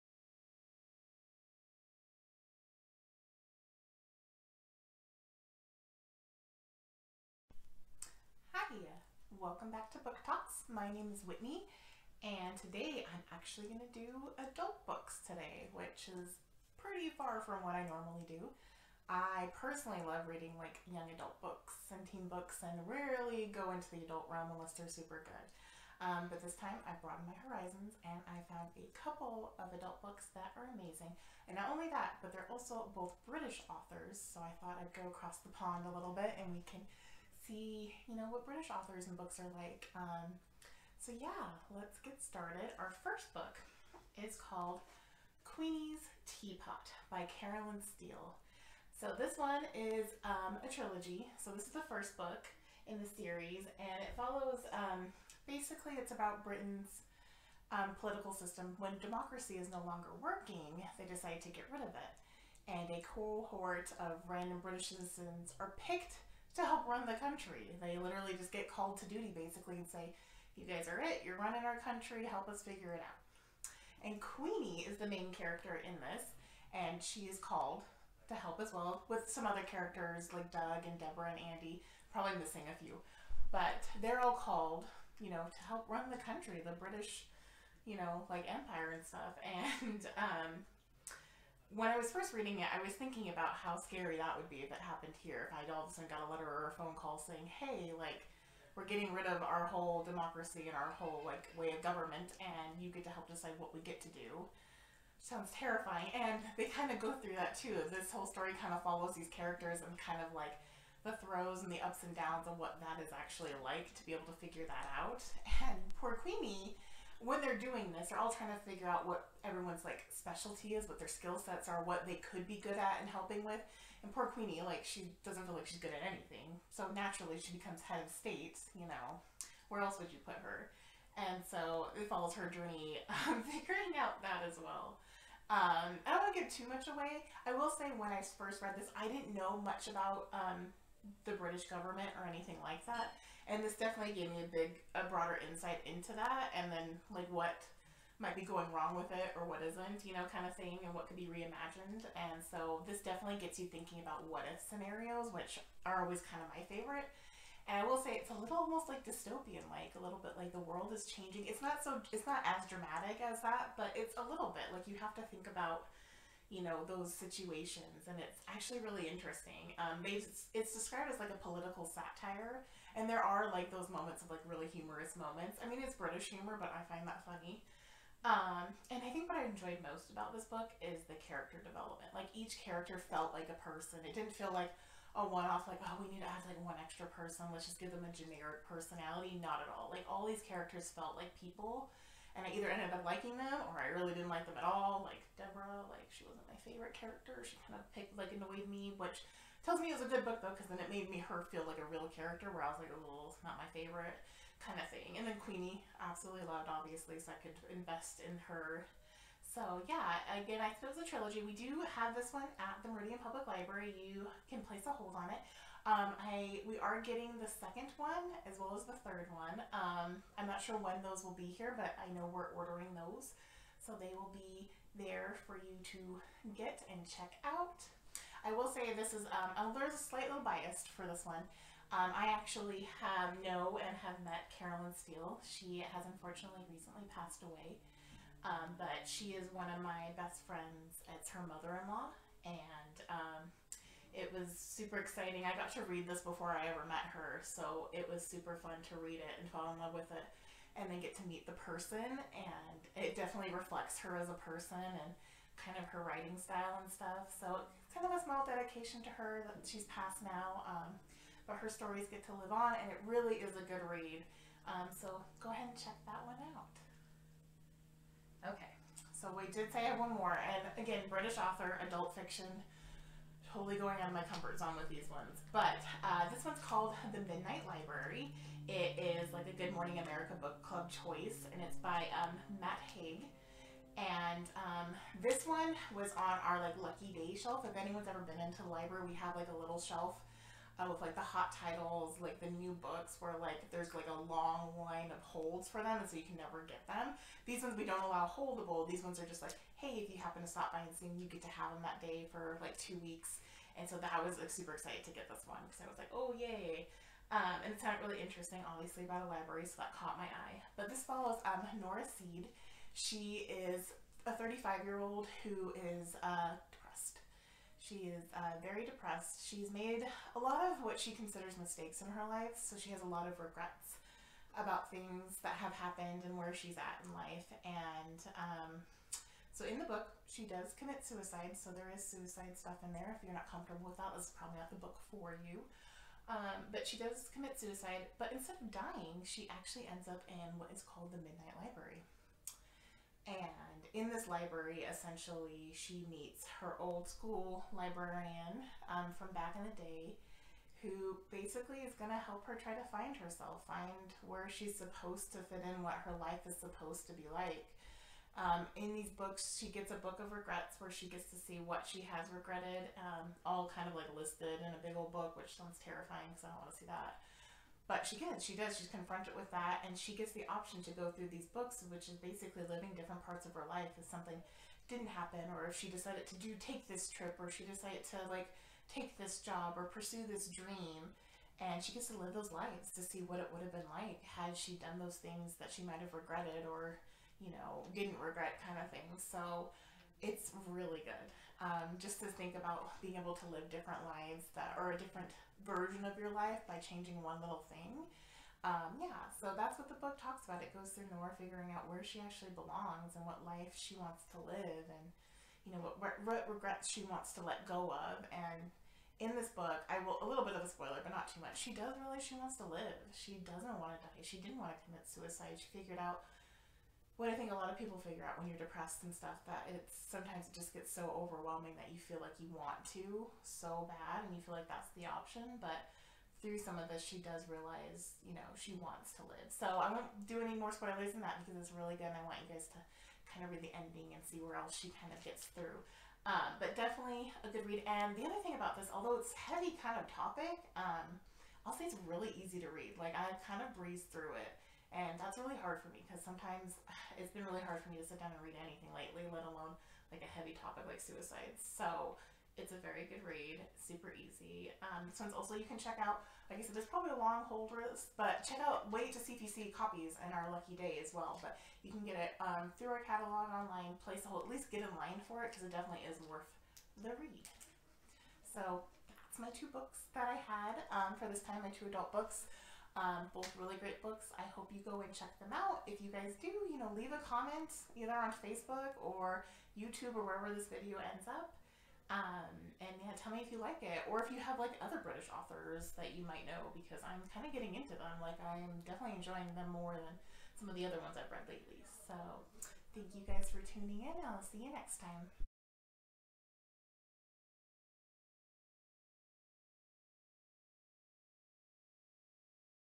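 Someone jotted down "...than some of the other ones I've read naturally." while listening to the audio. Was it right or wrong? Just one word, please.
wrong.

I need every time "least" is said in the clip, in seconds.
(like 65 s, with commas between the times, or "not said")
464 s.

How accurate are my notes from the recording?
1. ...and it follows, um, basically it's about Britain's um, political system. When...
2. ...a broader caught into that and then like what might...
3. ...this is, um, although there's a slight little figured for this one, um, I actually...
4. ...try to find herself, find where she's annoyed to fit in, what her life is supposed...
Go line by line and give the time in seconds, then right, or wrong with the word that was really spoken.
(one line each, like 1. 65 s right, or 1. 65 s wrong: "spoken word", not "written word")
1. 53 s right
2. 144 s wrong: "insight", not "caught"
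3. 228 s wrong: "biased", not "figured"
4. 352 s wrong: "supposed", not "annoyed".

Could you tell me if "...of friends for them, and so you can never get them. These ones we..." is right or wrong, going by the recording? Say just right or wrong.
wrong.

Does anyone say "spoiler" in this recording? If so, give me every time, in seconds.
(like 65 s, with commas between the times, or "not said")
410 s, 430 s.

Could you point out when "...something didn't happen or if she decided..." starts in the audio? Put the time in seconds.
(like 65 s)
374 s.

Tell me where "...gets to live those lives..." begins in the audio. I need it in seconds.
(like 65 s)
381 s.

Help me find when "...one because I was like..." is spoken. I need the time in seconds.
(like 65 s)
305 s.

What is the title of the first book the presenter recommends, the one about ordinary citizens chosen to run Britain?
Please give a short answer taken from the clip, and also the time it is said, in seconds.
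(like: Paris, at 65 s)
Queenie's Tea Pot, at 45 s.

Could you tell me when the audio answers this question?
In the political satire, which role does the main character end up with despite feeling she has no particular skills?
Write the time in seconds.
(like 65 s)
127 s.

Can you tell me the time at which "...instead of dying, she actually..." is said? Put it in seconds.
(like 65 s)
338 s.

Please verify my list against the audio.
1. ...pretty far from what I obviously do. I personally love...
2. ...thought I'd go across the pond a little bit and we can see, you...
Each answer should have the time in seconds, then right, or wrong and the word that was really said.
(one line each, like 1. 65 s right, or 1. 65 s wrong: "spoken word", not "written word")
1. 16 s wrong: "normally", not "obviously"
2. 34 s right.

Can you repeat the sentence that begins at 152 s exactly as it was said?
And so this definitely gets you thinking about what if scenarios, which are always kind of my favorite.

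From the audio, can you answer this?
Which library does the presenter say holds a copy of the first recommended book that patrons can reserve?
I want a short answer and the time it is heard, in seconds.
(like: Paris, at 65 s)
Meridian Public Library, at 212 s.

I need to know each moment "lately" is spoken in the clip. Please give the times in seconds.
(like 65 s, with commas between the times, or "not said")
448 s, 491 s.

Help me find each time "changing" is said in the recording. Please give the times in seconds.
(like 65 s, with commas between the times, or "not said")
161 s, 396 s.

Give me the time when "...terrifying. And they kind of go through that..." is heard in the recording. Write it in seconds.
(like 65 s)
105 s.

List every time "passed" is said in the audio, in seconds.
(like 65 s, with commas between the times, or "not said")
237 s, 259 s.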